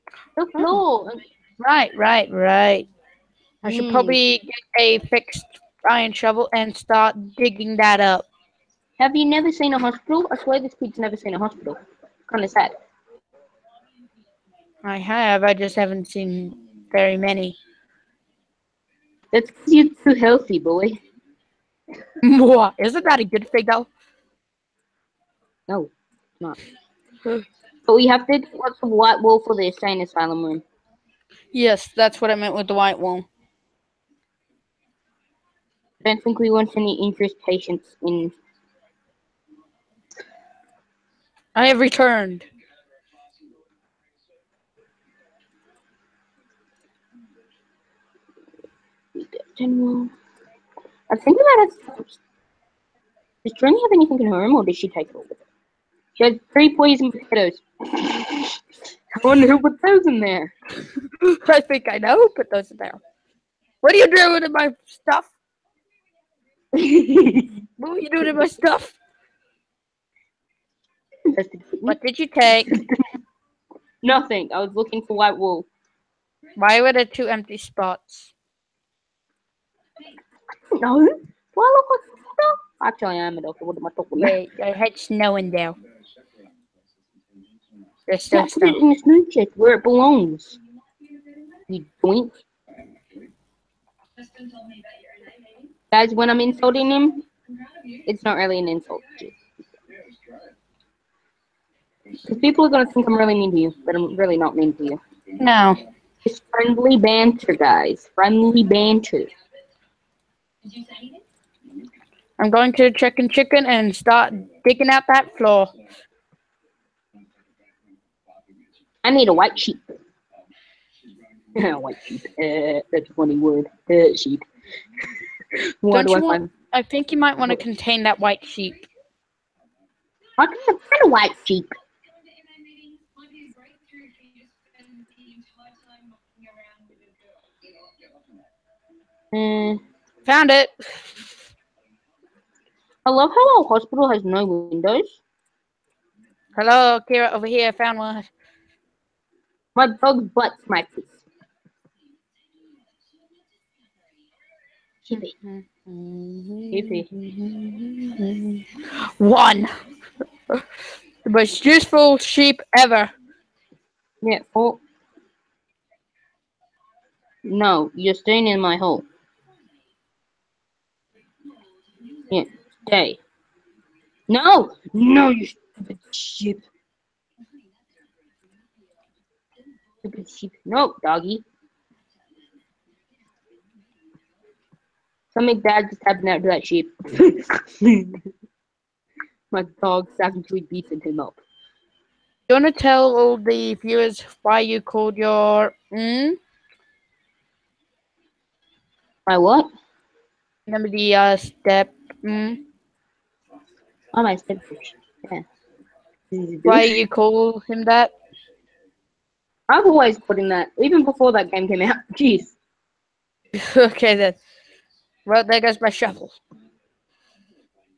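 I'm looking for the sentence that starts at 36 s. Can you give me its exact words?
I don't think we want any interest patients in.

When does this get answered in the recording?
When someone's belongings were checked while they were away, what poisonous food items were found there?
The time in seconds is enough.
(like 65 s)
56 s.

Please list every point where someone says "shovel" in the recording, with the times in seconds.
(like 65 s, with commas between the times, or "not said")
6 s, 215 s.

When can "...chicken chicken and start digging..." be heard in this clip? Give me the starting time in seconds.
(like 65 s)
112 s.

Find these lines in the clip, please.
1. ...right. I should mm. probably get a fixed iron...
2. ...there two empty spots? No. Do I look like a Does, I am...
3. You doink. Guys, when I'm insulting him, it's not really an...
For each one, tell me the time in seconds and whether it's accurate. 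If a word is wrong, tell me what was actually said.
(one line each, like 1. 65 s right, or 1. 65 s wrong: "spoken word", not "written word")
1. 2 s right
2. 76 s wrong: "Actually", not "Does"
3. 91 s right.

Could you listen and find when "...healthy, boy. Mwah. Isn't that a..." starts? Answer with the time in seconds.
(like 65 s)
20 s.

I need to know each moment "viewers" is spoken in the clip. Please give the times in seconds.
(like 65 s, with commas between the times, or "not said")
193 s.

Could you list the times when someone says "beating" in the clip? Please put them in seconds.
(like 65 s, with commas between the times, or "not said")
190 s.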